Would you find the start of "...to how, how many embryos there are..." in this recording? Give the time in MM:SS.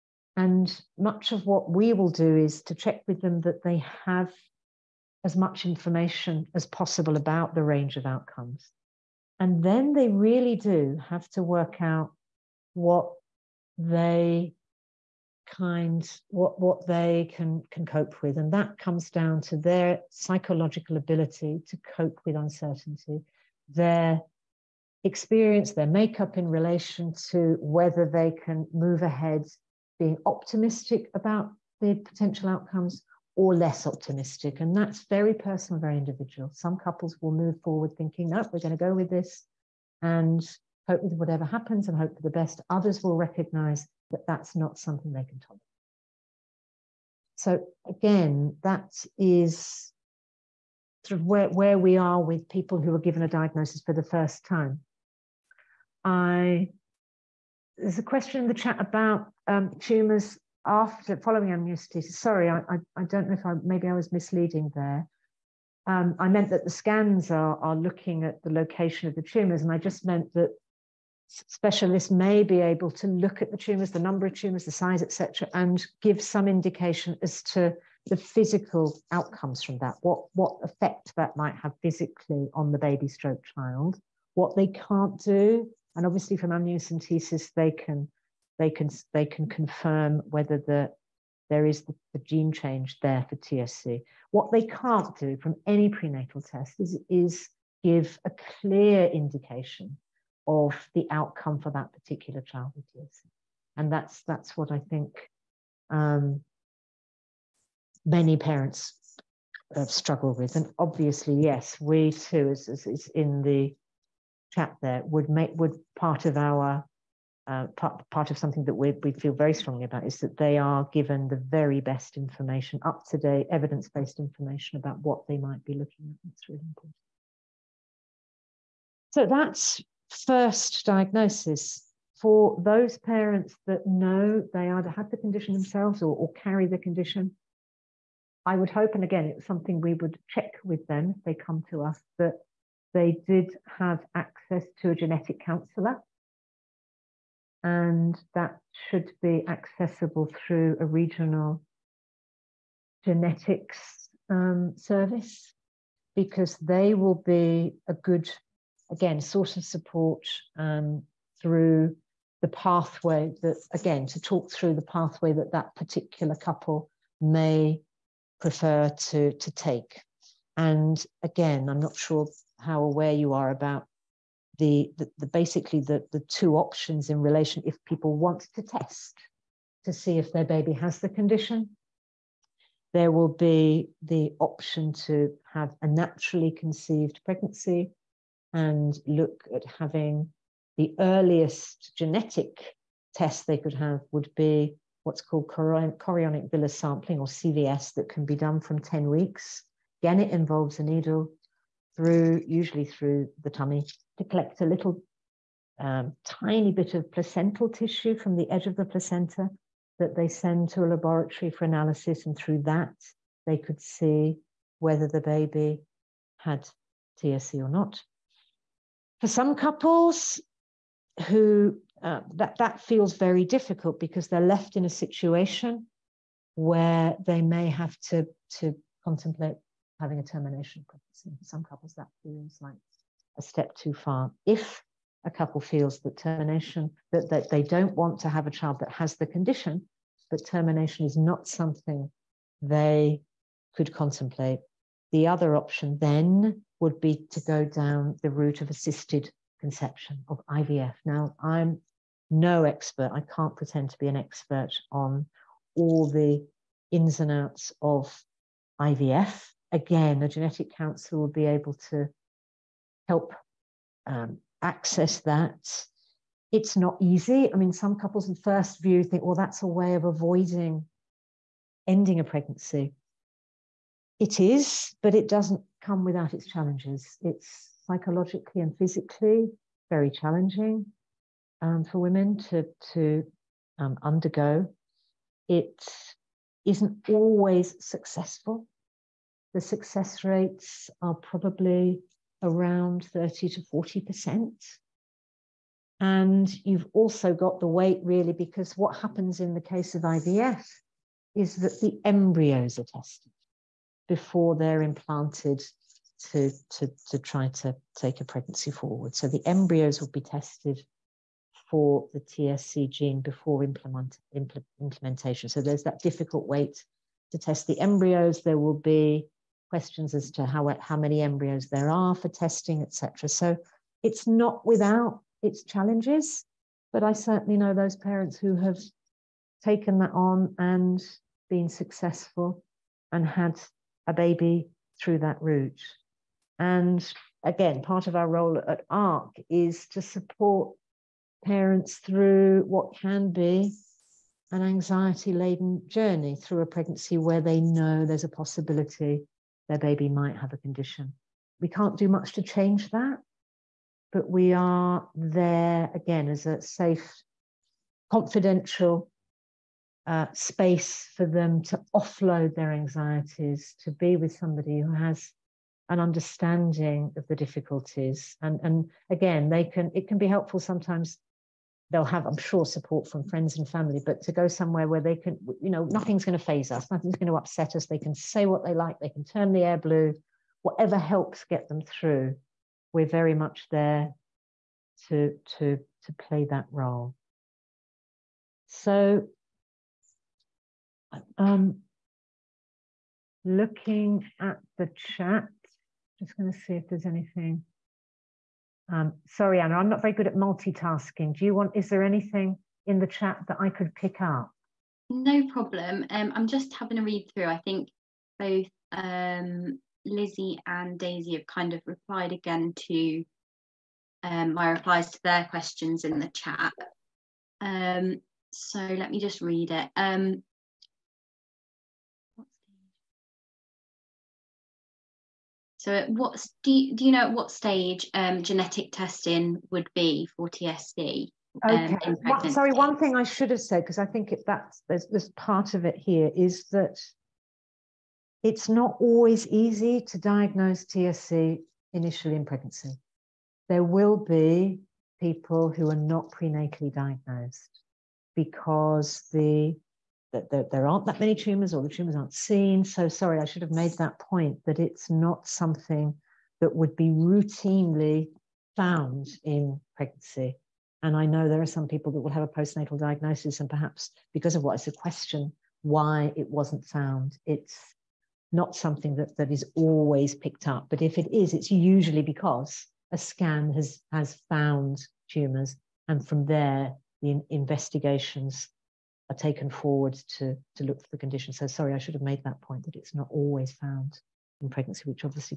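05:20.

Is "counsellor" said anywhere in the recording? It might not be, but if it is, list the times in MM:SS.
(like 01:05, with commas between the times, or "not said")
02:25, 04:20.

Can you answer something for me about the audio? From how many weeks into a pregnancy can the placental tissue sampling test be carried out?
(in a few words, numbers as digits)
10 weeks.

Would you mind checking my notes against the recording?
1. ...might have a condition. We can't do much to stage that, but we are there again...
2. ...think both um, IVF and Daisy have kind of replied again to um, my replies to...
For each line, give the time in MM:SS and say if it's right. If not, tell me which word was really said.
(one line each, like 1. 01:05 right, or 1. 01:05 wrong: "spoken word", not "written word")
1. 05:50 wrong: "change", not "stage"
2. 06:47 wrong: "Lizzie", not "IVF".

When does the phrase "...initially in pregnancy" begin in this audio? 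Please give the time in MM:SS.
07:21.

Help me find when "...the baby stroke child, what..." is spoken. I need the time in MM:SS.
01:22.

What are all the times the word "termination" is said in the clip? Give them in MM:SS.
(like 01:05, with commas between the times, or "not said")
03:50, 03:56, 04:00.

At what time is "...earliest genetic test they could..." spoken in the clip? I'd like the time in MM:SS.
03:10.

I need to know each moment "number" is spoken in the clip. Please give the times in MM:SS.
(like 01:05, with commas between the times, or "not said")
01:13.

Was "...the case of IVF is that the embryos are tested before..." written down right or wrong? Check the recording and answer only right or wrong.
right.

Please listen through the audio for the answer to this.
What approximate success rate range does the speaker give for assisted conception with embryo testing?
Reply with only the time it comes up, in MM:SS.
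04:53.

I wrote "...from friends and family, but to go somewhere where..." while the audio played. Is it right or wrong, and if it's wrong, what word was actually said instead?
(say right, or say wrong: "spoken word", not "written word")
right.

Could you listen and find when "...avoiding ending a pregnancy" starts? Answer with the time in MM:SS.
04:30.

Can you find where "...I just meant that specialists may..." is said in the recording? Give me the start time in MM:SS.
01:09.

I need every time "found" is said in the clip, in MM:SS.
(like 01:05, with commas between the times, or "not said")
07:38, 07:46, 07:54, 08:03.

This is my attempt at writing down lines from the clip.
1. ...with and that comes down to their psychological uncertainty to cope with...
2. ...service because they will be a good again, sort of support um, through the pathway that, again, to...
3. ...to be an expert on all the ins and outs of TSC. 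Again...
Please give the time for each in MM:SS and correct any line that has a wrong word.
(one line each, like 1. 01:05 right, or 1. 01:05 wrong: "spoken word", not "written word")
1. 00:18 wrong: "ability", not "uncertainty"
2. 02:34 right
3. 04:13 wrong: "IVF", not "TSC".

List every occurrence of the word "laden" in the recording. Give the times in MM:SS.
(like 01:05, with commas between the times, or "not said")
05:45.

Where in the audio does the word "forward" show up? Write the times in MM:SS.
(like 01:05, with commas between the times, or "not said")
00:37, 05:08, 07:59.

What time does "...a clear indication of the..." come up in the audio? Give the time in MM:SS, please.
01:38.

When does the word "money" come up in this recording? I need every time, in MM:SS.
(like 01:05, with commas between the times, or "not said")
not said.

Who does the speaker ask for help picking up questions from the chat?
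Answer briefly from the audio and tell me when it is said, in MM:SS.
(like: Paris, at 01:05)
Anna, at 06:39.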